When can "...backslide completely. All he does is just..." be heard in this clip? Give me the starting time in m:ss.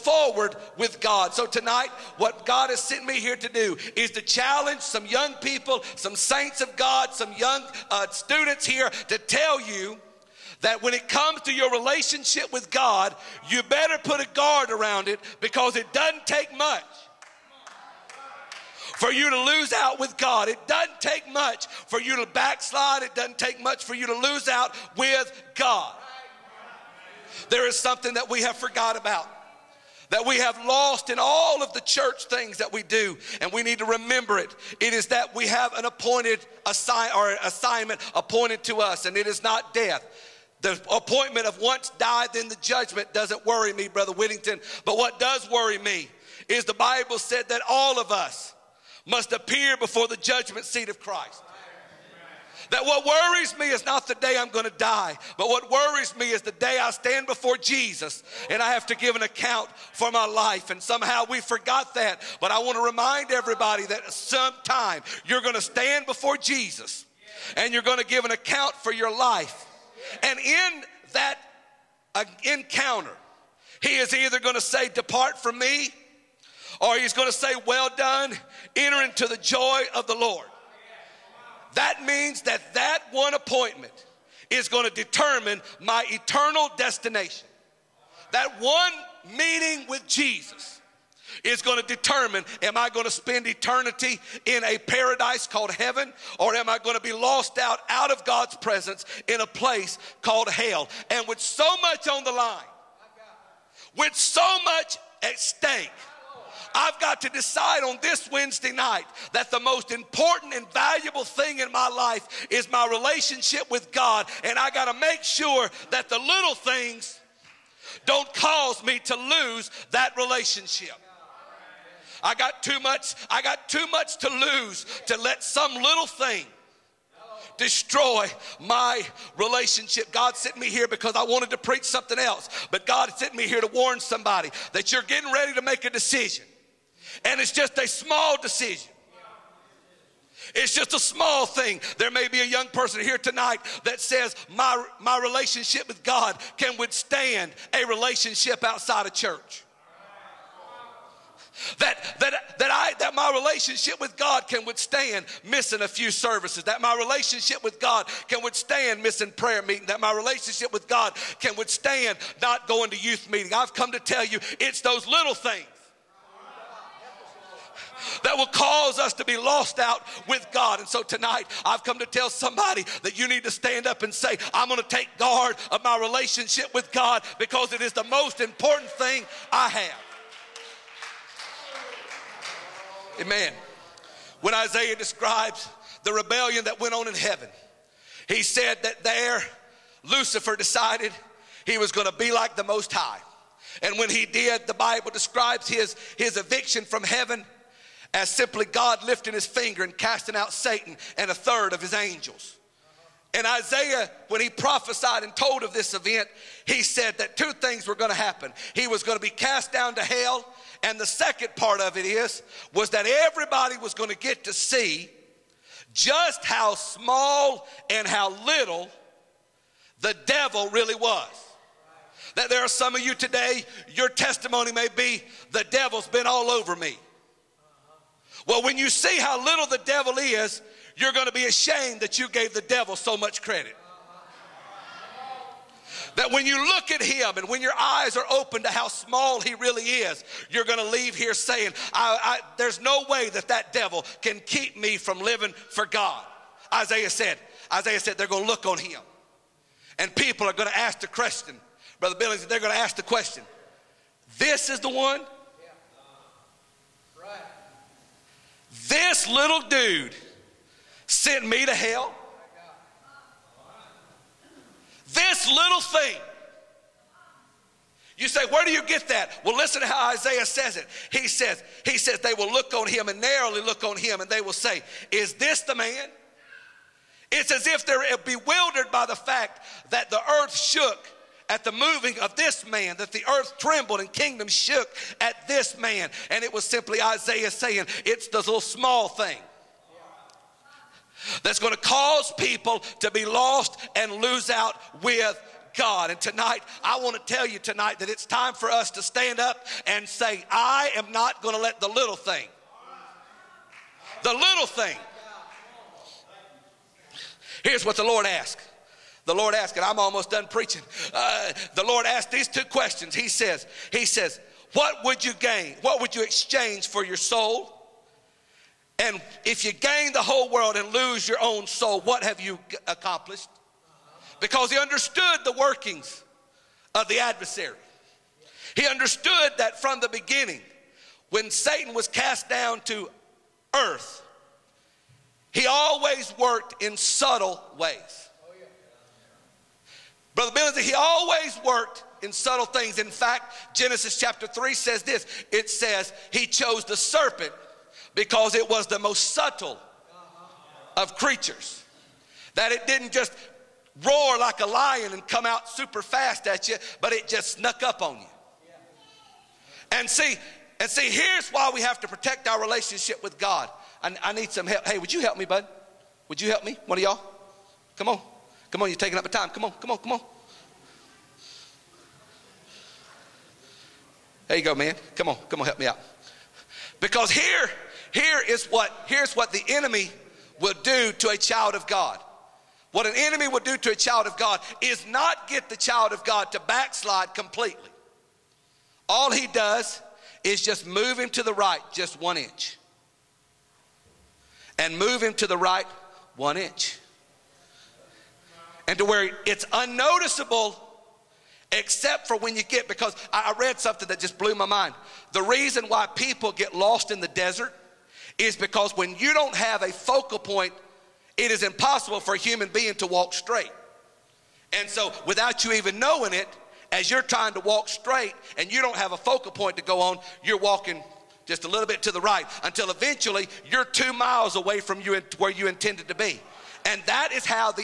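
6:26.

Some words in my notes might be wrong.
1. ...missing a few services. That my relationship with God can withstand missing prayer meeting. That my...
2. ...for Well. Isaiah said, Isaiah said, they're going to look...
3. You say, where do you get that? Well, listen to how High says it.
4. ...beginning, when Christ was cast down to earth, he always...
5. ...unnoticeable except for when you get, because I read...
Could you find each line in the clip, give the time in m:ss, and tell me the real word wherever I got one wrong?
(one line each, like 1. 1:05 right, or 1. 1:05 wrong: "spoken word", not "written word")
1. 2:35 right
2. 4:05 wrong: "God", not "Well"
3. 4:28 wrong: "Isaiah", not "High"
4. 5:30 wrong: "Satan", not "Christ"
5. 6:39 right.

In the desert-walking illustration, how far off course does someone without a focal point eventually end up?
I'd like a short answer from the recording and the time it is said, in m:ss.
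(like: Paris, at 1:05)
2 miles, at 7:03.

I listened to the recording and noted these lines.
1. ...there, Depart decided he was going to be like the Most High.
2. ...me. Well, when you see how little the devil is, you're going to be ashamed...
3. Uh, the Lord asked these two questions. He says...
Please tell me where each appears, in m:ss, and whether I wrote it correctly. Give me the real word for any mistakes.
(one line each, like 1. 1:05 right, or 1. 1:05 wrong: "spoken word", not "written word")
1. 3:09 wrong: "Lucifer", not "Depart"
2. 3:46 right
3. 5:11 right.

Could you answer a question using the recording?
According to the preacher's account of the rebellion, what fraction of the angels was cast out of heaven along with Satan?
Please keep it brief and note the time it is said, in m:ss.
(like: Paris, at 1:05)
a third, at 3:21.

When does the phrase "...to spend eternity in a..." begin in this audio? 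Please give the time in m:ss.
1:33.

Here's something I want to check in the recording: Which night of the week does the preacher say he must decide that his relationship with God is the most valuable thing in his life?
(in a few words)
Wednesday.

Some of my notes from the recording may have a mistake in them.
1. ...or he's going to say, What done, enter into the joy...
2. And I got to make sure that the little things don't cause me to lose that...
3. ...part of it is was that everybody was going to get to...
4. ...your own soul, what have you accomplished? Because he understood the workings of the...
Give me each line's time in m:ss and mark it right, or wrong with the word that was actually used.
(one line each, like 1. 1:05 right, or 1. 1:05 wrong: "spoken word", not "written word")
1. 1:16 wrong: "Well", not "What"
2. 1:54 right
3. 3:31 right
4. 5:21 right.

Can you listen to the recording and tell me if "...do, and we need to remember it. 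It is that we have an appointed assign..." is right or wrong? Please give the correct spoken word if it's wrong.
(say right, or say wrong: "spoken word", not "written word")
right.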